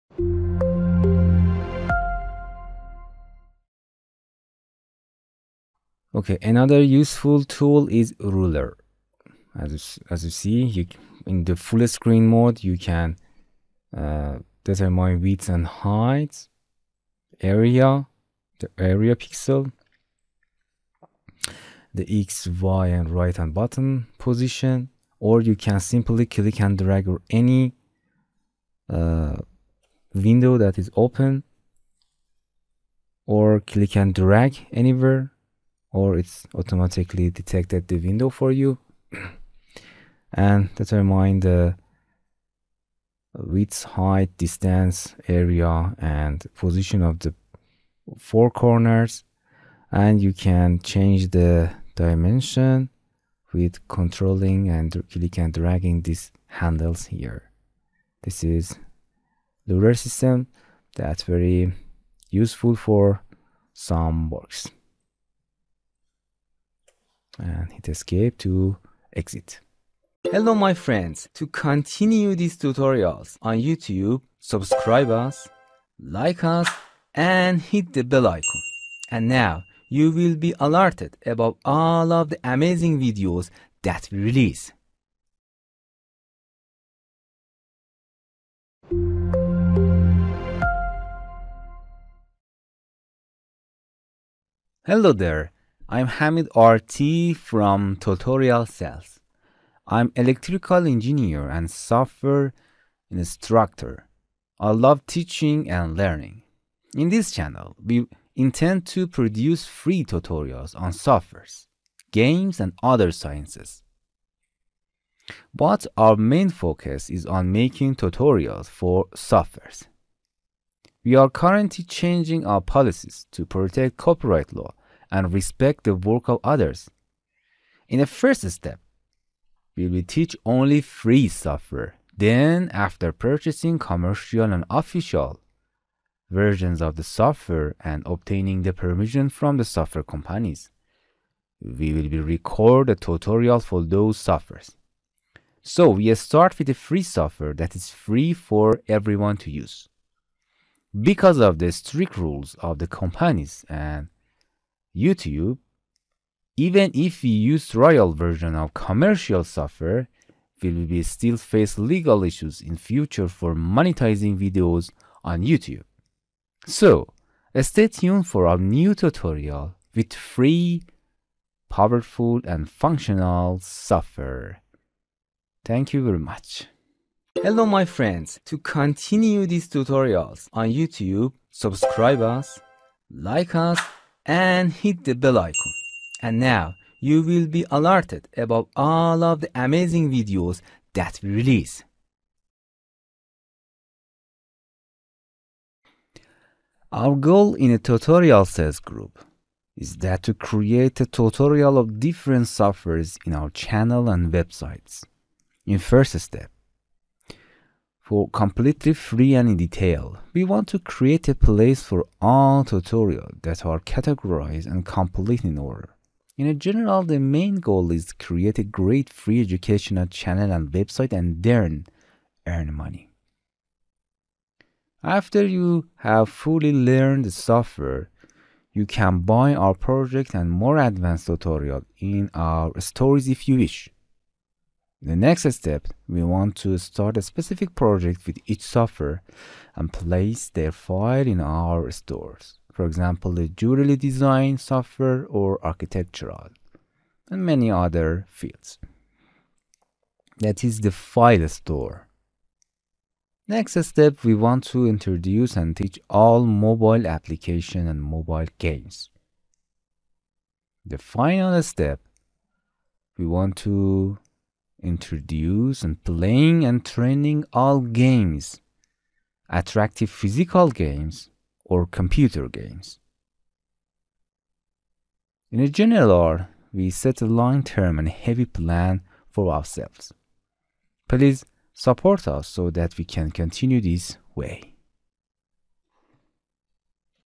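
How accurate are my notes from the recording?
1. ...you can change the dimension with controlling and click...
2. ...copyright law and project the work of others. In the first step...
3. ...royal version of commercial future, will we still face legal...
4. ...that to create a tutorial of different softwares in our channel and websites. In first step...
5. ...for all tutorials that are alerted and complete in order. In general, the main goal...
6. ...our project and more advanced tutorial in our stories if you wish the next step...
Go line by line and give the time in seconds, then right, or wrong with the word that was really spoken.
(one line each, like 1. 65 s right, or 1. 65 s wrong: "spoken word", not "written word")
1. 50 s right
2. 123 s wrong: "respect", not "project"
3. 157 s wrong: "software", not "future"
4. 199 s right
5. 211 s wrong: "categorized", not "alerted"
6. 229 s right.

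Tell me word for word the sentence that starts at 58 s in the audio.
This is Lunar system that's very useful for some works and hit escape to exit.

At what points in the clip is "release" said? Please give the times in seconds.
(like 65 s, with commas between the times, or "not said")
84 s, 191 s.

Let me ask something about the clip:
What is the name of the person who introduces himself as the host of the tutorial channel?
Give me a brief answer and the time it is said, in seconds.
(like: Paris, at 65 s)
Hamid RT, at 96 s.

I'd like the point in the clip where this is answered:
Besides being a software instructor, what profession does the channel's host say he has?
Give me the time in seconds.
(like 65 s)
100 s.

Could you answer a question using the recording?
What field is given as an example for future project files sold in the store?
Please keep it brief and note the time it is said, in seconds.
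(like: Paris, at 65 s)
Jewelry design, at 243 s.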